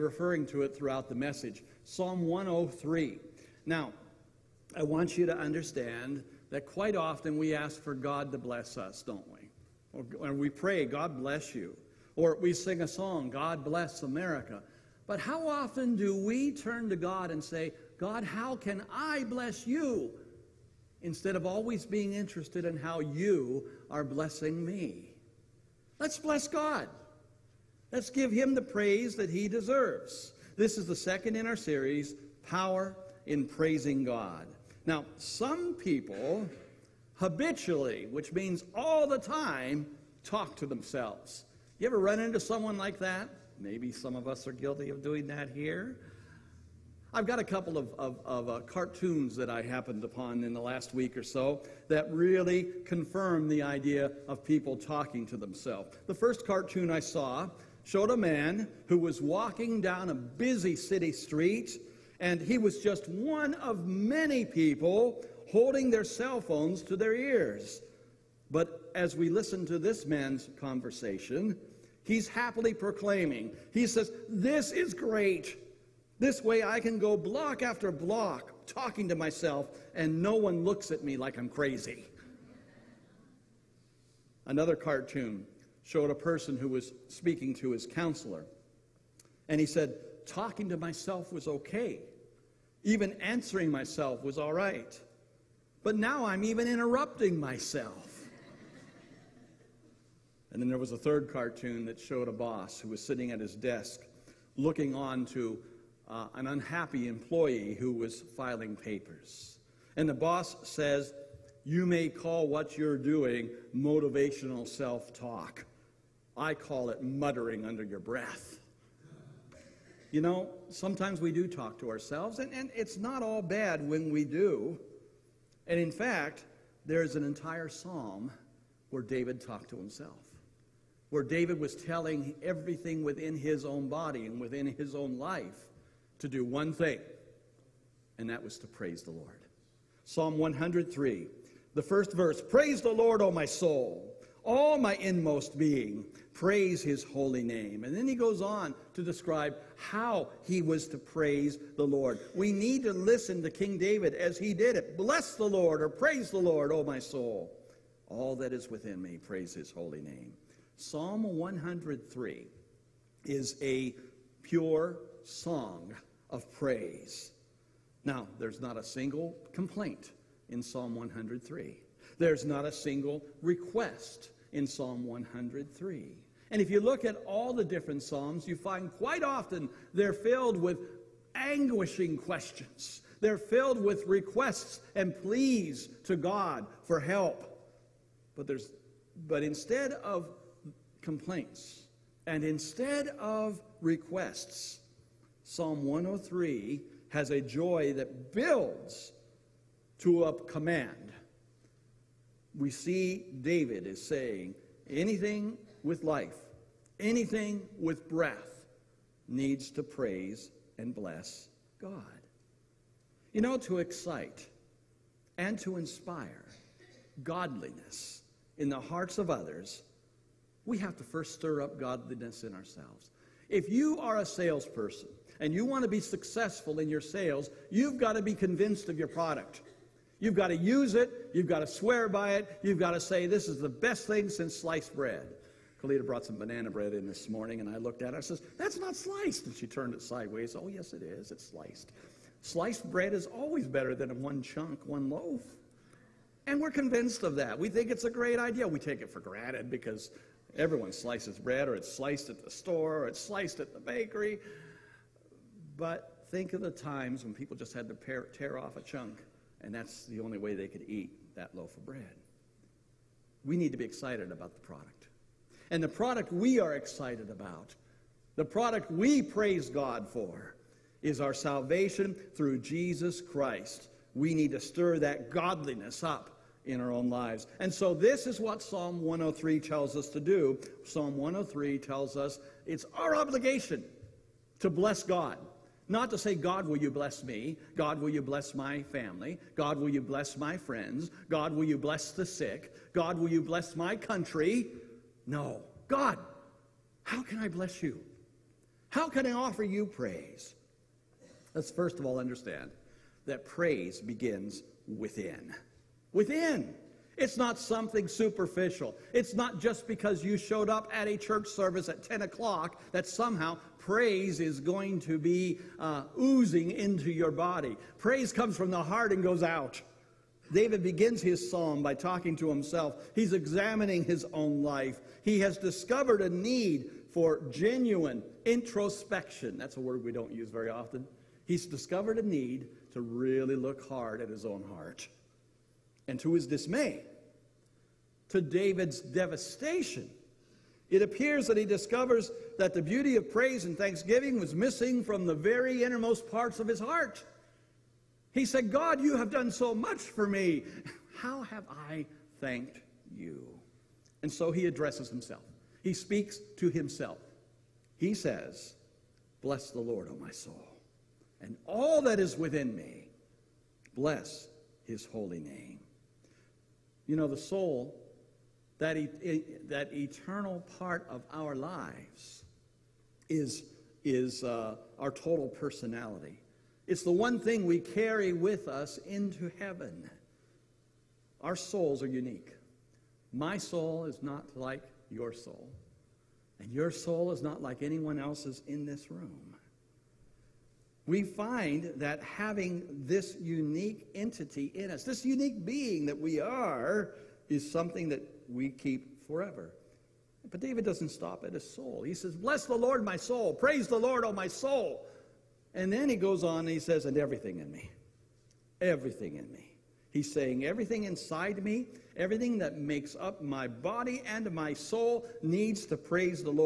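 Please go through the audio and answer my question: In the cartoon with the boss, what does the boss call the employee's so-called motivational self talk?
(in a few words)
muttering under your breath.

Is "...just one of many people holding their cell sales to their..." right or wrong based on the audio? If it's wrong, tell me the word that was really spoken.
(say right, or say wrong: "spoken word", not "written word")
wrong: "phones", not "sales".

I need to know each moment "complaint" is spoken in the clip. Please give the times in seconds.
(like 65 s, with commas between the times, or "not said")
169 s, 191 s.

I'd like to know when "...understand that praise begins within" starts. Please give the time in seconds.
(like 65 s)
302 s.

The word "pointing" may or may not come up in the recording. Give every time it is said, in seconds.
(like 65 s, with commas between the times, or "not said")
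not said.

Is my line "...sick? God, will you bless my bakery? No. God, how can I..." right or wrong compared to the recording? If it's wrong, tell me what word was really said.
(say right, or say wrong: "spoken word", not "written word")
wrong: "country", not "bakery".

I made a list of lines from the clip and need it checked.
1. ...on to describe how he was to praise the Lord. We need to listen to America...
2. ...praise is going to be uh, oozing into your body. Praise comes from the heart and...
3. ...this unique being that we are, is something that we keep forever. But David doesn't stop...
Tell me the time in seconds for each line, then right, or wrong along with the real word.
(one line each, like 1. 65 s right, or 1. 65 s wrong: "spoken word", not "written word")
1. 148 s wrong: "King", not "America"
2. 313 s right
3. 395 s right.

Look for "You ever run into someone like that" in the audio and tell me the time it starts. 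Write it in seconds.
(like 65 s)
41 s.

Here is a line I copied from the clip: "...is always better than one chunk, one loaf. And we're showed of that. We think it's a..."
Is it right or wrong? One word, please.
wrong.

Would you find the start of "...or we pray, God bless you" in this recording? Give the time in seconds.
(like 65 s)
10 s.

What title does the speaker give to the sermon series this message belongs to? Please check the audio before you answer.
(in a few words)
Power in praising God.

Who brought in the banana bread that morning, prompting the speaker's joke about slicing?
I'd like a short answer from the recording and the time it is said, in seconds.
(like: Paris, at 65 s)
Kalita, at 235 s.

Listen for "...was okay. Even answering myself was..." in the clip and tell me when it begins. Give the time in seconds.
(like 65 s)
91 s.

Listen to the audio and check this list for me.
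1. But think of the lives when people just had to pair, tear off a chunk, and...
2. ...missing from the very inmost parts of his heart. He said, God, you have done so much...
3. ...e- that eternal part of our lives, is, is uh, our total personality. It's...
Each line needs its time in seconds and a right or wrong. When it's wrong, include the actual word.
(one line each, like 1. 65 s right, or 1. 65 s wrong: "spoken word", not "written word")
1. 255 s wrong: "times", not "lives"
2. 344 s wrong: "innermost", not "inmost"
3. 368 s right.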